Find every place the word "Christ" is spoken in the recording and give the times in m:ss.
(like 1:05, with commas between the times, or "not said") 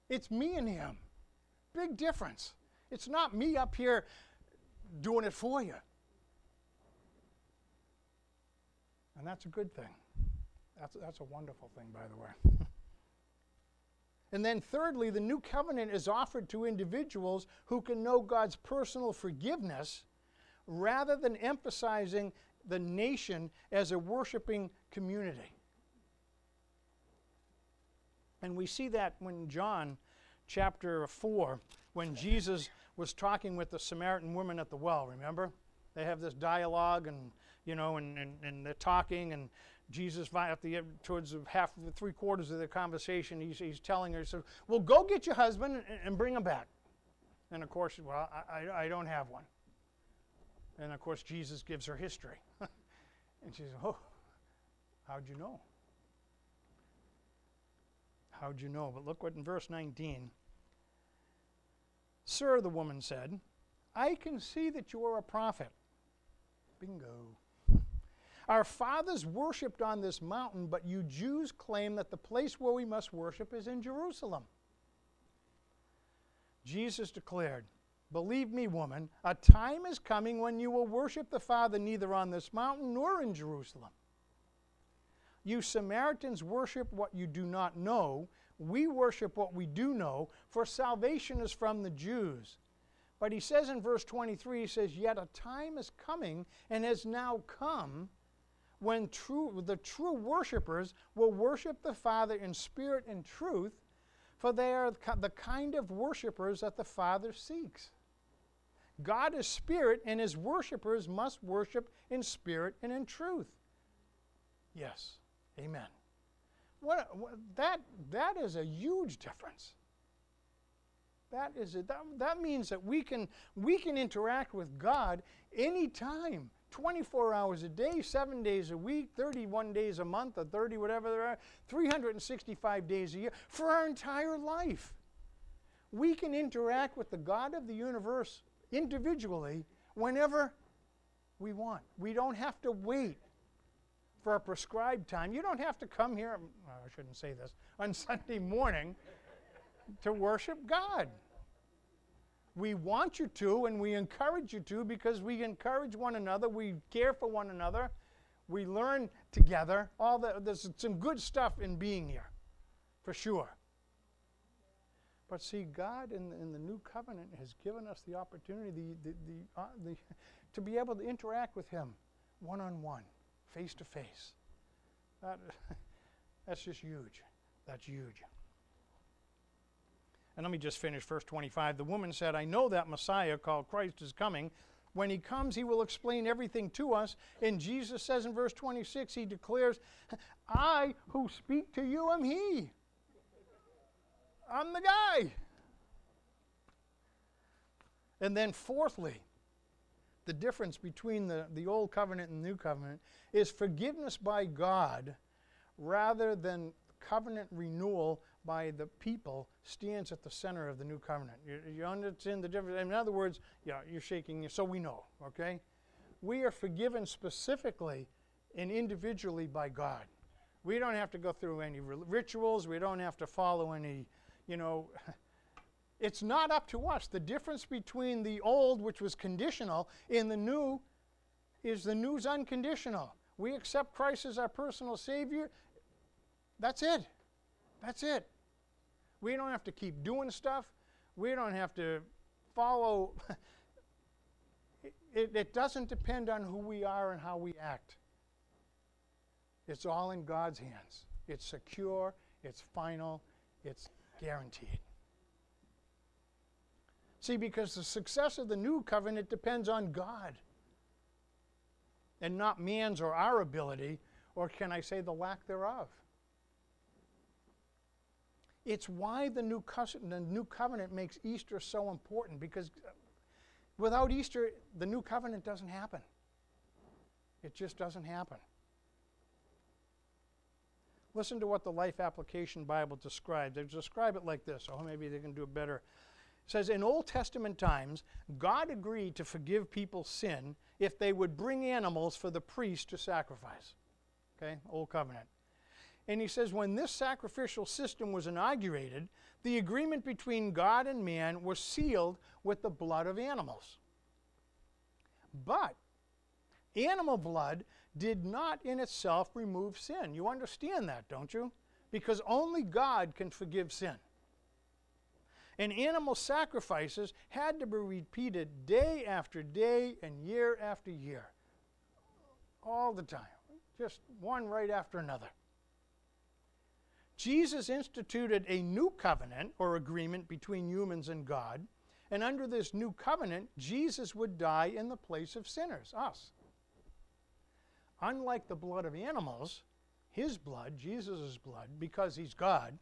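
3:03, 3:53.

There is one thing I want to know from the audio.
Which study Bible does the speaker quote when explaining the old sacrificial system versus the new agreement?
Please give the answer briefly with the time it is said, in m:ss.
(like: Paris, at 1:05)
Life Application Bible, at 4:41.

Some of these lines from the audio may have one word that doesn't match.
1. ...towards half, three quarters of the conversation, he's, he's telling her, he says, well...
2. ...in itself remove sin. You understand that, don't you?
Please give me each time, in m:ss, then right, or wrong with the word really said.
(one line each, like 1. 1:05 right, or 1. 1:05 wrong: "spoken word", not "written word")
1. 0:41 right
2. 5:08 right.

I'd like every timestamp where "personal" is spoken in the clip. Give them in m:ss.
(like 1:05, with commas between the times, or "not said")
0:18, 3:54.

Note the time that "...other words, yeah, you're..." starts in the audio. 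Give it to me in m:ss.
3:32.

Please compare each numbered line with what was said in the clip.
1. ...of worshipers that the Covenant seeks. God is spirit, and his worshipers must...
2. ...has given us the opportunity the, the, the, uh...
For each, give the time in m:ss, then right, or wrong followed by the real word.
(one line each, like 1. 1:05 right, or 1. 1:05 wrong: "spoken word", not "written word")
1. 1:45 wrong: "Father", not "Covenant"
2. 2:47 right.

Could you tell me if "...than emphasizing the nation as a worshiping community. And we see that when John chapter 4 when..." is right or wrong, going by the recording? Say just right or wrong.
right.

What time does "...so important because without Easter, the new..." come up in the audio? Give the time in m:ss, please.
4:31.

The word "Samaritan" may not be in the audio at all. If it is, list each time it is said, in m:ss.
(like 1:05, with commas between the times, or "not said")
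0:33, 1:25.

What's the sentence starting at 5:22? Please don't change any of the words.
All the time, just one right after another.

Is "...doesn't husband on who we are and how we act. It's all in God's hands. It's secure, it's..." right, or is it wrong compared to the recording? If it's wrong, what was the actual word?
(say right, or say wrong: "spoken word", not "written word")
wrong: "depend", not "husband".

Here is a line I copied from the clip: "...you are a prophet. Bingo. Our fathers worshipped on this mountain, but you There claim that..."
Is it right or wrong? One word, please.
wrong.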